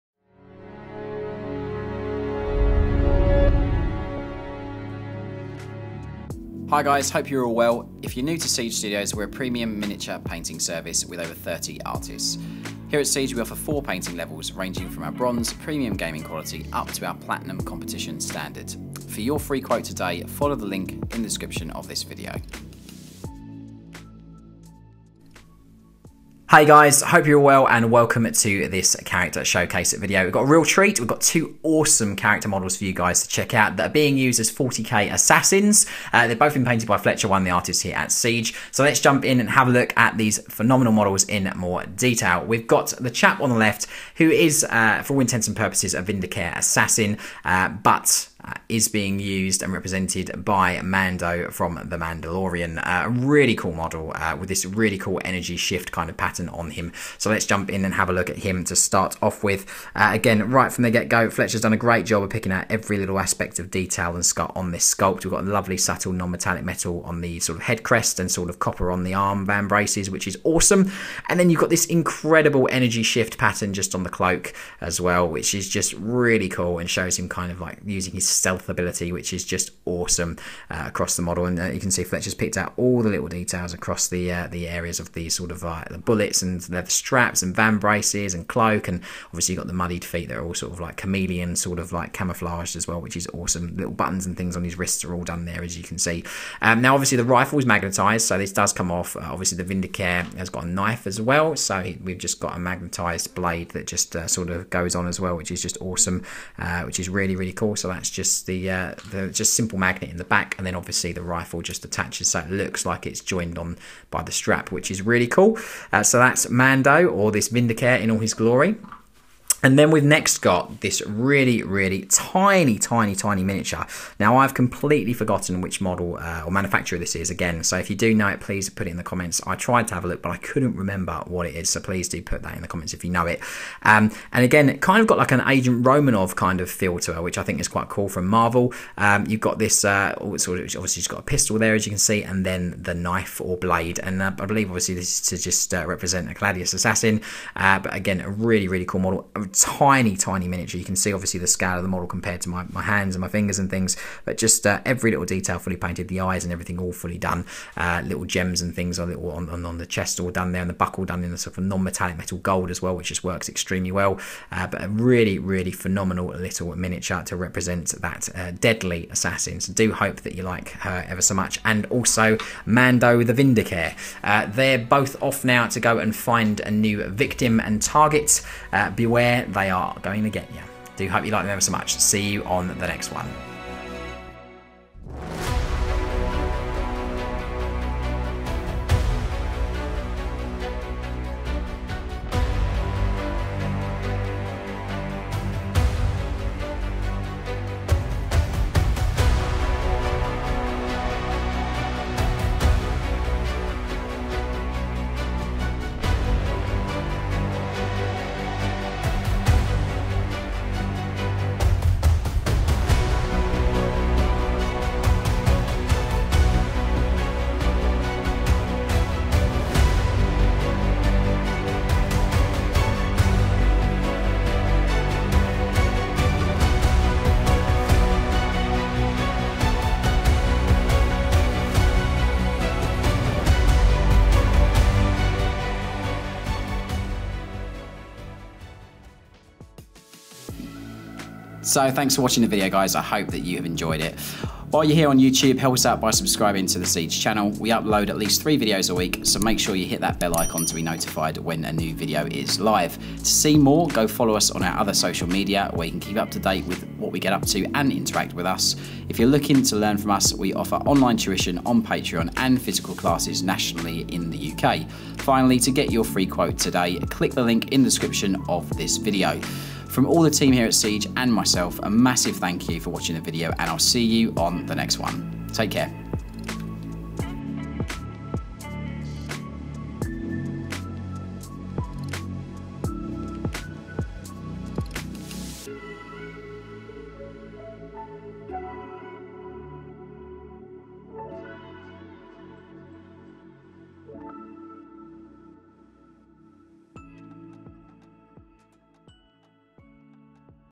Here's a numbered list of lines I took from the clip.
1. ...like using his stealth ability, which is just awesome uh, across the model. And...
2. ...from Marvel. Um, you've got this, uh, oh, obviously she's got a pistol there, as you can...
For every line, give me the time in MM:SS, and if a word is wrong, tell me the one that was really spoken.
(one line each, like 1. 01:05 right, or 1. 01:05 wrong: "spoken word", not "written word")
1. 01:17 right
2. 02:18 right.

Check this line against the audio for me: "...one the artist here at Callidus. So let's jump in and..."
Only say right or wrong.
wrong.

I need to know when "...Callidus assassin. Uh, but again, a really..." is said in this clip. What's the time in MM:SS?
02:26.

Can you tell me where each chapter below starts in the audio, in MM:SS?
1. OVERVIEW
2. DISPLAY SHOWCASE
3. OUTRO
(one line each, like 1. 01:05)
1. 00:25
2. 03:04
3. 04:00.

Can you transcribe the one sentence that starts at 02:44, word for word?
Uh, but a really, really phenomenal little miniature to represent that uh, deadly assassin.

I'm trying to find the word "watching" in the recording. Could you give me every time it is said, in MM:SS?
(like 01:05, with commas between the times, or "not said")
04:02, 04:32.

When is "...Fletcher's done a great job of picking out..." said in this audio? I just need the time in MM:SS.
01:01.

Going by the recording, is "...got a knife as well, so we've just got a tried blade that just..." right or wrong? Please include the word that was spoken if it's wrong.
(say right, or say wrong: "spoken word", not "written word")
wrong: "magnetized", not "tried".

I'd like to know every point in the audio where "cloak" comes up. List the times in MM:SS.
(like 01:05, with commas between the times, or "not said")
01:14, 01:28.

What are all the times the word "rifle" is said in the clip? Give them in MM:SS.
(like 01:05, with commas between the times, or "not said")
01:37, 01:51.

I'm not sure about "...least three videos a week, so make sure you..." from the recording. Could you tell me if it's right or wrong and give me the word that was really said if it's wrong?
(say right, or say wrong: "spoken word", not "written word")
right.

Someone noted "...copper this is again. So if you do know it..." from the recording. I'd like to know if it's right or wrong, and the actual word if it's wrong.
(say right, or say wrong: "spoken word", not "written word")
wrong: "manufacturer", not "copper".